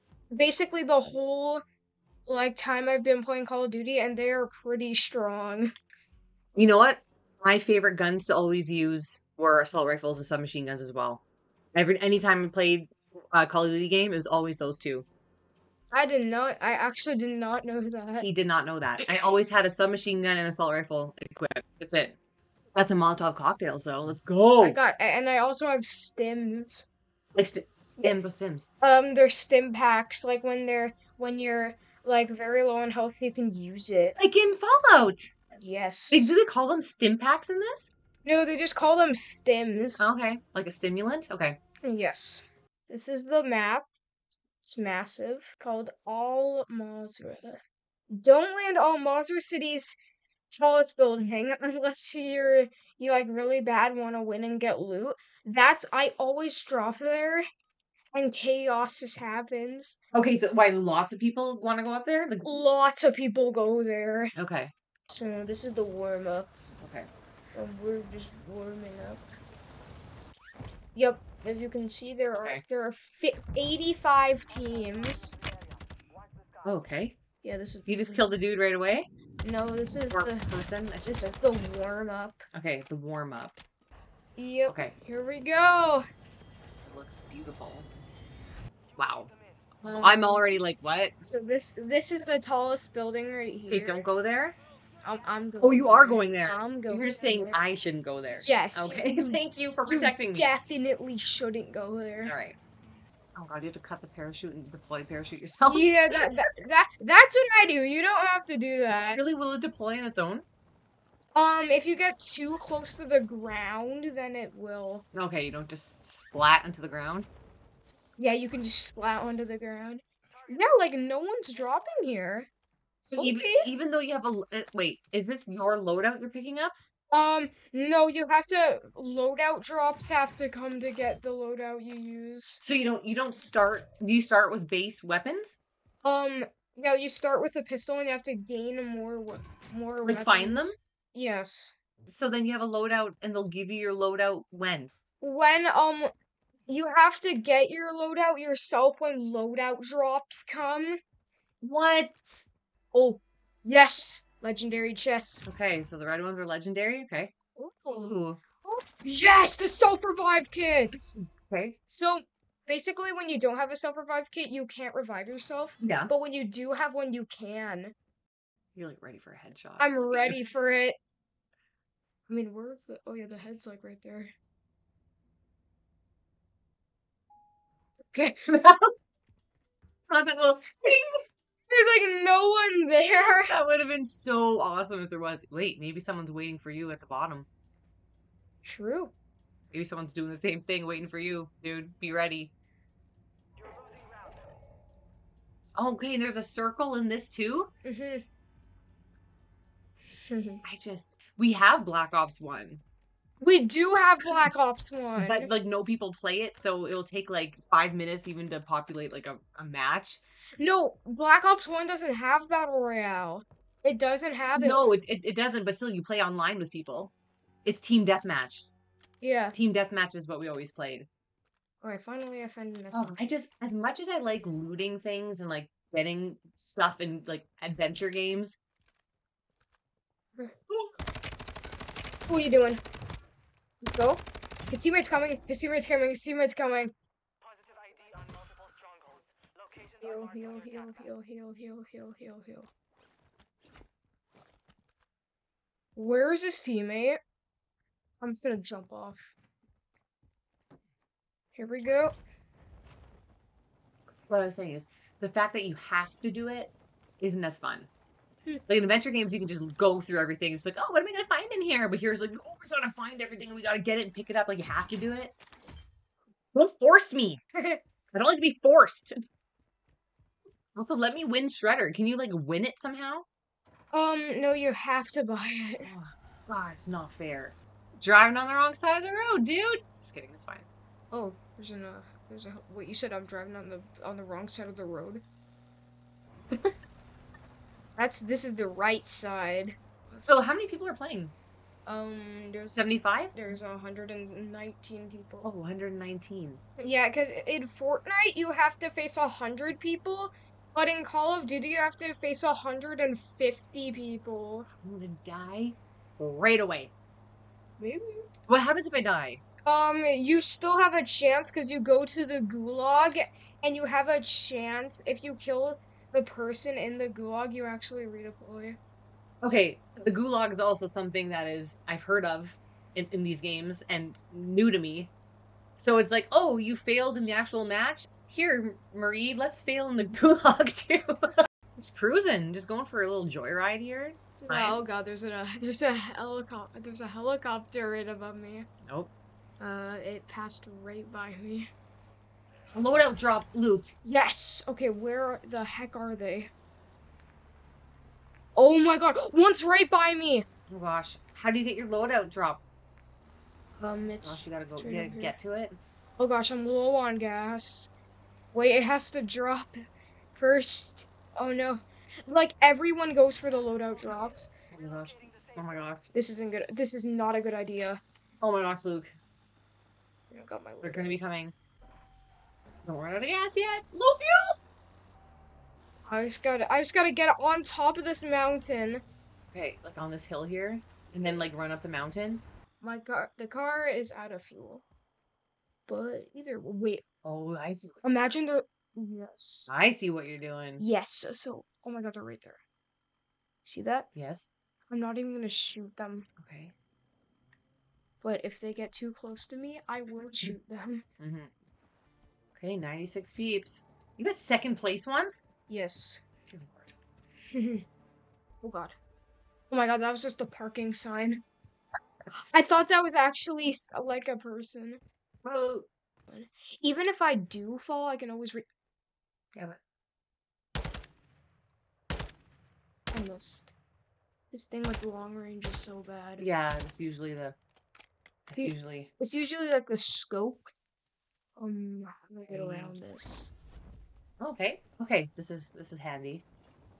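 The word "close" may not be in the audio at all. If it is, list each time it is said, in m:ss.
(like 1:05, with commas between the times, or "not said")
1:52, 6:39.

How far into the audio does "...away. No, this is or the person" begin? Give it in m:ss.
1:18.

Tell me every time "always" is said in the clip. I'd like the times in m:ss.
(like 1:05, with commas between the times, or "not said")
0:08, 0:14, 0:19, 0:56, 3:40, 6:58.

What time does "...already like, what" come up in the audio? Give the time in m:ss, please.
1:30.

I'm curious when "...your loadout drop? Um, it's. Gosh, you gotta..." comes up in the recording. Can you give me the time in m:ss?
5:51.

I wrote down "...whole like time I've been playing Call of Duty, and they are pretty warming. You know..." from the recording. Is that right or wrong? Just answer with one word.
wrong.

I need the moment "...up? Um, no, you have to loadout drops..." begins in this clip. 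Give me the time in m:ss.
2:06.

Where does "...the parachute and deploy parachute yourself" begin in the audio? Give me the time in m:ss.
1:44.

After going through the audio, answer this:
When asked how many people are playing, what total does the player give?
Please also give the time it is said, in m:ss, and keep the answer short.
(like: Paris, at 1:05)
119, at 4:53.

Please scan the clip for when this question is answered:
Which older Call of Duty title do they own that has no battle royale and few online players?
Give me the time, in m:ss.
3:21.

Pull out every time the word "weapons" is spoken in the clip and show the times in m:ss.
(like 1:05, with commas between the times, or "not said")
2:15, 2:20.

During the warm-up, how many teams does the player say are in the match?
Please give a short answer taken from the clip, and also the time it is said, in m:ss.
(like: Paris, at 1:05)
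85, at 1:13.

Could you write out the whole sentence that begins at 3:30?
No, Black Ops One doesn't have battle royale.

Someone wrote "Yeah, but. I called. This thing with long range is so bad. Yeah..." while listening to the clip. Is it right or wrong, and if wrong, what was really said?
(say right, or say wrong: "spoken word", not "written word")
wrong: "missed", not "called".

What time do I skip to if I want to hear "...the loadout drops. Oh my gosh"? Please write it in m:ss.
6:03.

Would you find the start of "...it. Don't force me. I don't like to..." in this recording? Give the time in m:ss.
4:25.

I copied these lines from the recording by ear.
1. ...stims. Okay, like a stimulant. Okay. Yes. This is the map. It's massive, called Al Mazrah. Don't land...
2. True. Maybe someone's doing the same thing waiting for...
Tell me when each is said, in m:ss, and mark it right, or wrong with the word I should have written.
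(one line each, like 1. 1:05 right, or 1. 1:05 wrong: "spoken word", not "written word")
1. 0:39 right
2. 3:08 right.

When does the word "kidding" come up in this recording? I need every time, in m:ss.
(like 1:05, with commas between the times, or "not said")
4:40.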